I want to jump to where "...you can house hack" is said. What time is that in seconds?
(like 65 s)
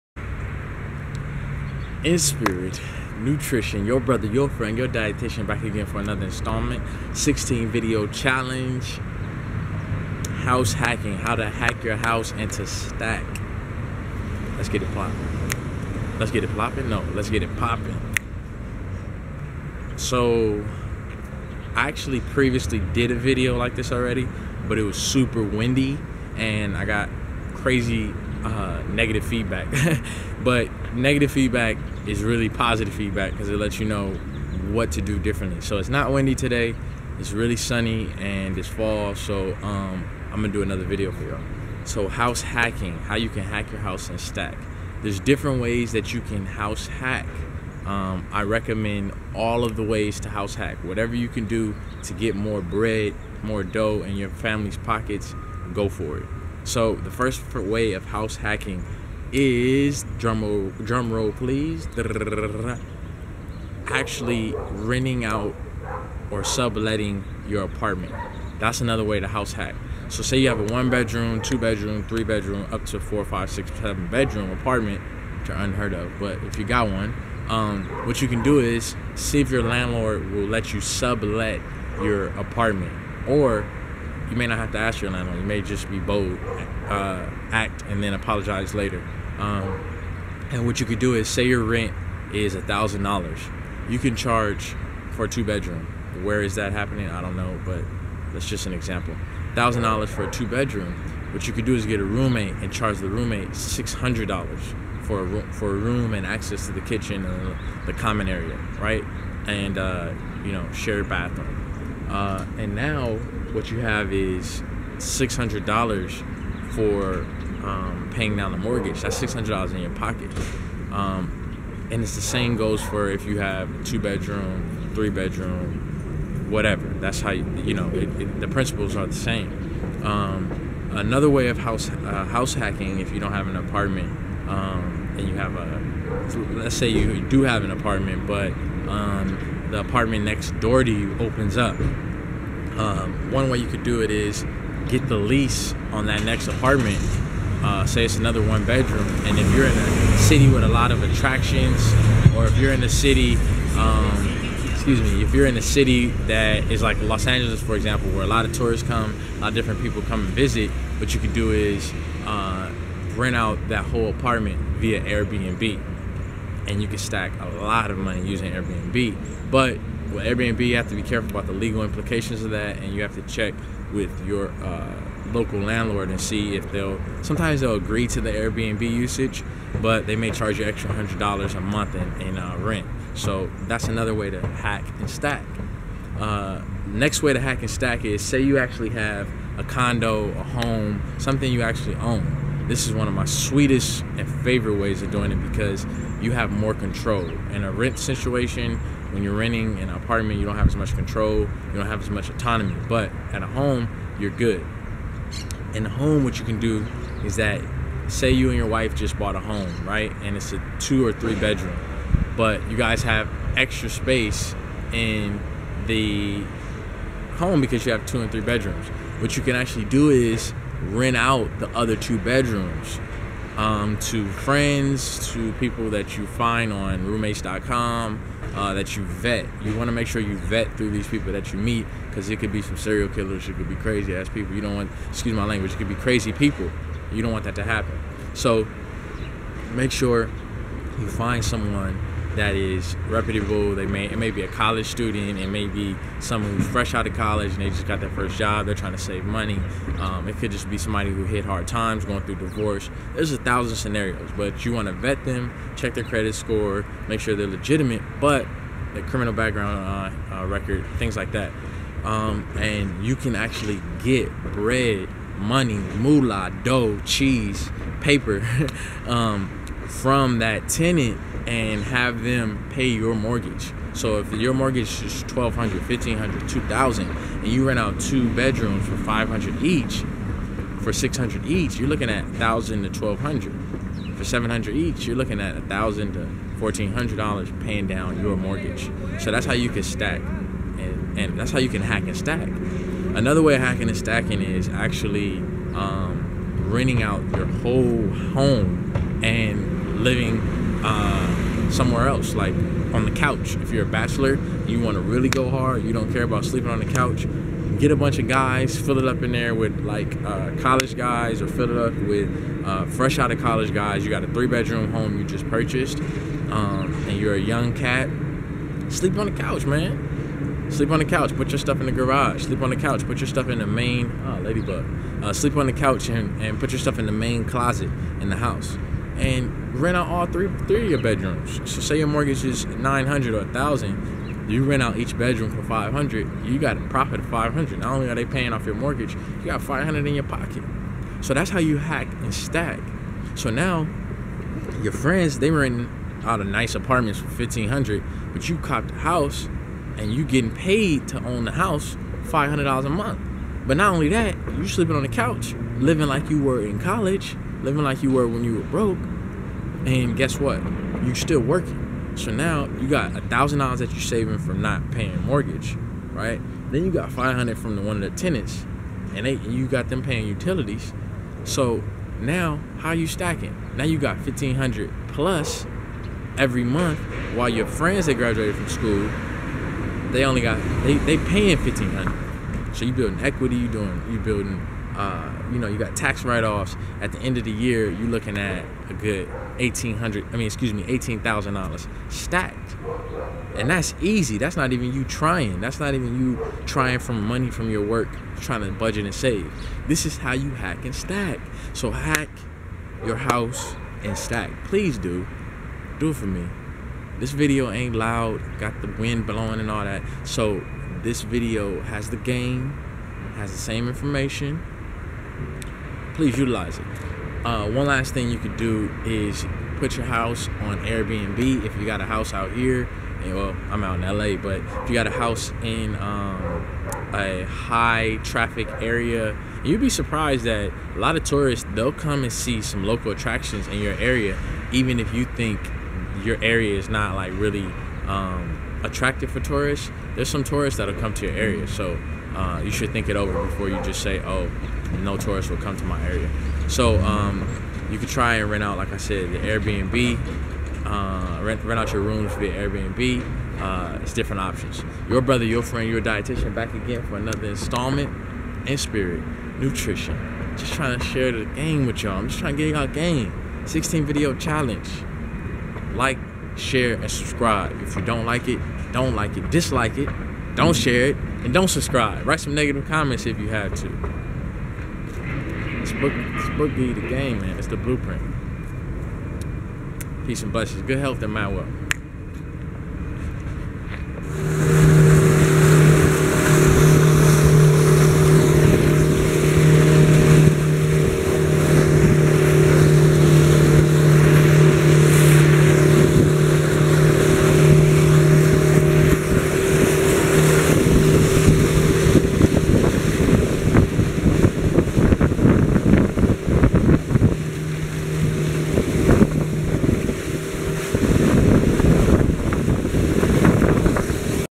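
46 s.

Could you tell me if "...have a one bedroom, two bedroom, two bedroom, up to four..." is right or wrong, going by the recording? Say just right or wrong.
wrong.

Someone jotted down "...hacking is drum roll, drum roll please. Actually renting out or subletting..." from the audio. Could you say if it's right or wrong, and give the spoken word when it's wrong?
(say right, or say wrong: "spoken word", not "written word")
right.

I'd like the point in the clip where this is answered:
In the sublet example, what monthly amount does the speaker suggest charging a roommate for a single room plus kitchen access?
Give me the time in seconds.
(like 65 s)
103 s.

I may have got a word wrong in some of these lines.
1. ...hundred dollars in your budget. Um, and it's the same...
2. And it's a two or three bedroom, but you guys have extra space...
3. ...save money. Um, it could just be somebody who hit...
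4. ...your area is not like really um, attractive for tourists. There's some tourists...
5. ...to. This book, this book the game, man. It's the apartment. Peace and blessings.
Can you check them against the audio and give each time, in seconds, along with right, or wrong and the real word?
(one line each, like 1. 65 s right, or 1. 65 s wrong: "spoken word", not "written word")
1. 119 s wrong: "pocket", not "budget"
2. 210 s right
3. 248 s right
4. 436 s right
5. 473 s wrong: "blueprint", not "apartment".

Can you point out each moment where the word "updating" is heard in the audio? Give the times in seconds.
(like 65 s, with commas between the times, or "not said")
not said.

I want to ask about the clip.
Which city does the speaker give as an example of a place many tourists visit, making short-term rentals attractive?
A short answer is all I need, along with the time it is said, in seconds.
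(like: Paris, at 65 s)
Los Angeles, at 157 s.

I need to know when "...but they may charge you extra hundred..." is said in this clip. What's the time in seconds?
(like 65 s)
179 s.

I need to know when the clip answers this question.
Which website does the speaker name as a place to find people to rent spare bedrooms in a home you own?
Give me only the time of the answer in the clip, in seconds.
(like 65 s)
227 s.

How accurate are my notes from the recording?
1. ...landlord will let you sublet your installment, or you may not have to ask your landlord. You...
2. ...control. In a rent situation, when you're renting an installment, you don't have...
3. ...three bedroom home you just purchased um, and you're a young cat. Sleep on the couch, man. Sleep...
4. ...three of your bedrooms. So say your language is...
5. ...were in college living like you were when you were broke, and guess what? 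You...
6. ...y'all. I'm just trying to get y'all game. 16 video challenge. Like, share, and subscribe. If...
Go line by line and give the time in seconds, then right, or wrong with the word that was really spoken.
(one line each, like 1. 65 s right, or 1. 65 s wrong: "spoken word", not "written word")
1. 79 s wrong: "apartment", not "installment"
2. 196 s wrong: "apartment", not "installment"
3. 314 s right
4. 330 s wrong: "mortgage", not "language"
5. 356 s right
6. 462 s right.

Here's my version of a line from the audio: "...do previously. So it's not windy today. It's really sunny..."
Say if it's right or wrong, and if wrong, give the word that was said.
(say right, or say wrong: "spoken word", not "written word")
wrong: "differently", not "previously".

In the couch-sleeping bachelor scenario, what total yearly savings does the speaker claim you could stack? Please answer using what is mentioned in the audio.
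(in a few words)
$18,000.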